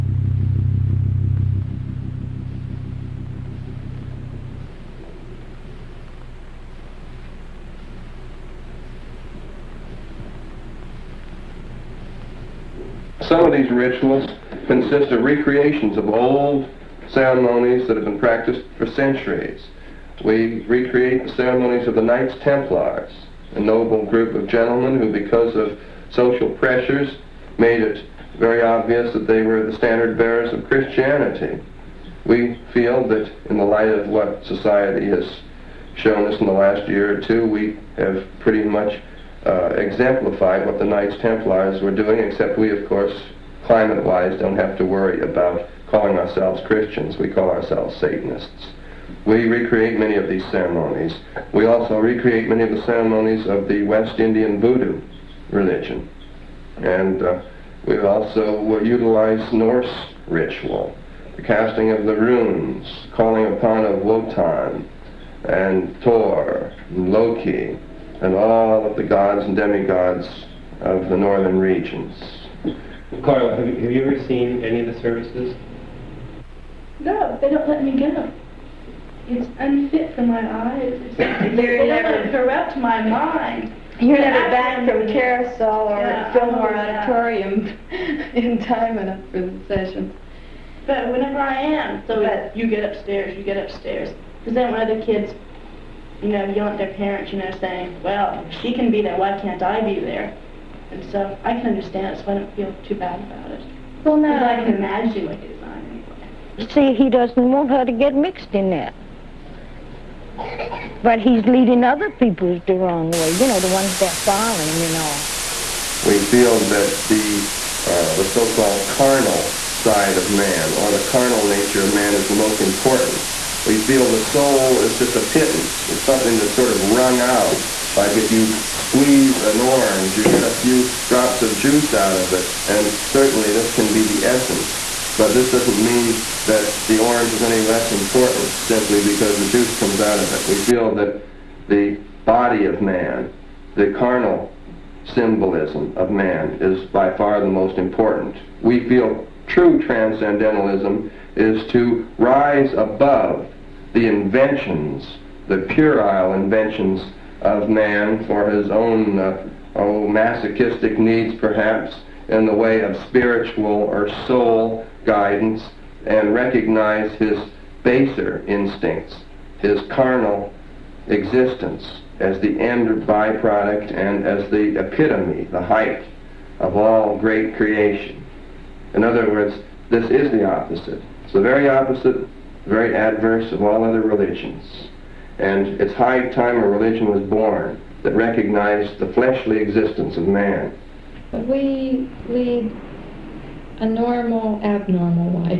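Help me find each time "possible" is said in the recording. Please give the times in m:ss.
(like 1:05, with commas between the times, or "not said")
not said.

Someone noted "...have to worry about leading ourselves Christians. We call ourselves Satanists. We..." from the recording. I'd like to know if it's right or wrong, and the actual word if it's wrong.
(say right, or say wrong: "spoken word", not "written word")
wrong: "calling", not "leading".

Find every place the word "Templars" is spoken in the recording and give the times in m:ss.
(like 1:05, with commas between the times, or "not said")
0:22, 0:41.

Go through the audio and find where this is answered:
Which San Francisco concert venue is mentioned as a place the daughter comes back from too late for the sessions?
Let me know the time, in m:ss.
1:26.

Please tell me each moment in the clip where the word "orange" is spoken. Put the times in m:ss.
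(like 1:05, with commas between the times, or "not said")
2:09, 2:16.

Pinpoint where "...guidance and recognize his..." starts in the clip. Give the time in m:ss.
2:45.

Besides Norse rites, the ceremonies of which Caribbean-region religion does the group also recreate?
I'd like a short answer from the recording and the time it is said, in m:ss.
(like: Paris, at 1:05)
West Indian Voodoo, at 0:53.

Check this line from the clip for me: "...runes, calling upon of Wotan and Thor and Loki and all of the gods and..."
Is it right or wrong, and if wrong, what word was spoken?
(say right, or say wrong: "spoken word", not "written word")
right.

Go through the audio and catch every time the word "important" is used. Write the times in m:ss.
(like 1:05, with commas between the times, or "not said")
2:02, 2:17, 2:27.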